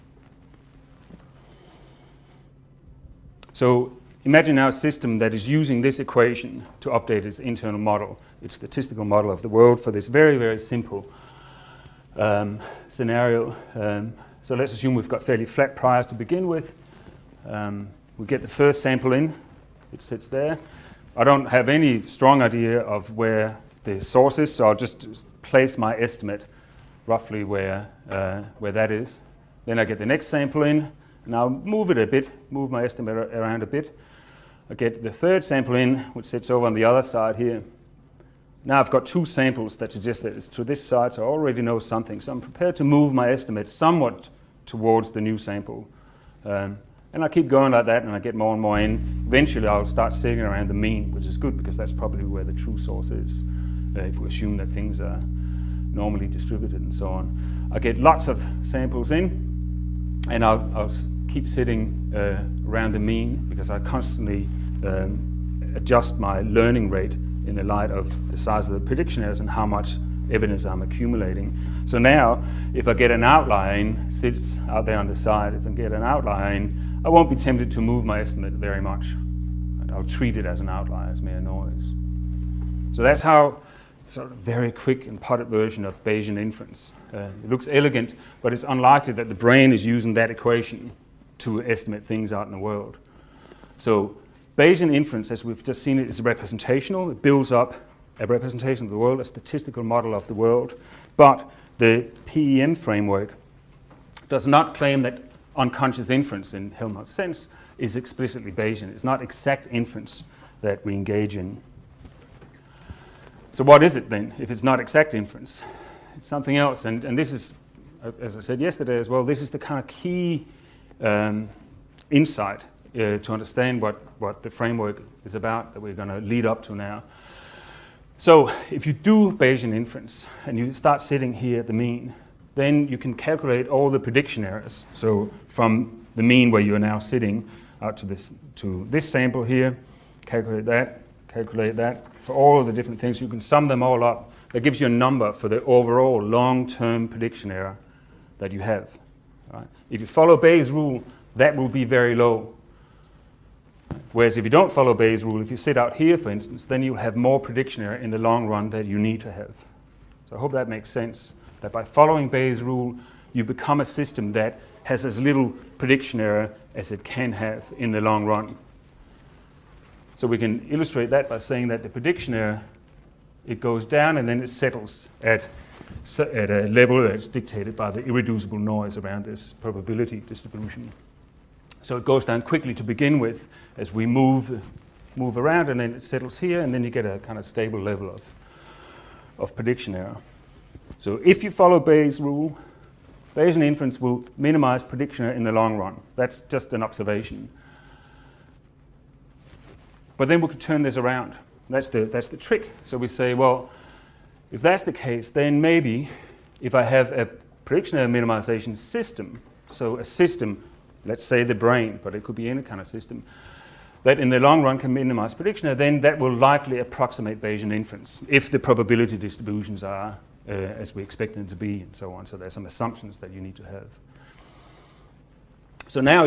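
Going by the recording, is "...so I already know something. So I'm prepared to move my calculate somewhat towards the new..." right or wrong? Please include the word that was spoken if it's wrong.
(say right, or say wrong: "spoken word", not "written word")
wrong: "estimate", not "calculate".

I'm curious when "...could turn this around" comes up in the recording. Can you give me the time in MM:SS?
03:20.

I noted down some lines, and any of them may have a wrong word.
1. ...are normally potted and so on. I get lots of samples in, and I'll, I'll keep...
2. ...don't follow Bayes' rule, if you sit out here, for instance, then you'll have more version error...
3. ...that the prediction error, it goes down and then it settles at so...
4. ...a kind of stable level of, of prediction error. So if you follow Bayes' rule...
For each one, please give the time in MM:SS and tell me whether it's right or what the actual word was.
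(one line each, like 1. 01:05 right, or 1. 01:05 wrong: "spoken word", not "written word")
1. 00:55 wrong: "distributed", not "potted"
2. 02:34 wrong: "prediction", not "version"
3. 02:51 right
4. 03:07 right.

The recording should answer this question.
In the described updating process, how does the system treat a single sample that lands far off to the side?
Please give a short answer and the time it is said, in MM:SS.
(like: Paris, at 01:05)
as mere noise, at 01:21.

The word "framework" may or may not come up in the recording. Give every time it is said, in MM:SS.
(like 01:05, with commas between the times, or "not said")
01:42, 02:04.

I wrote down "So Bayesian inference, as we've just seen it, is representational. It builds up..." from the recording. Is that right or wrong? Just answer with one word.
right.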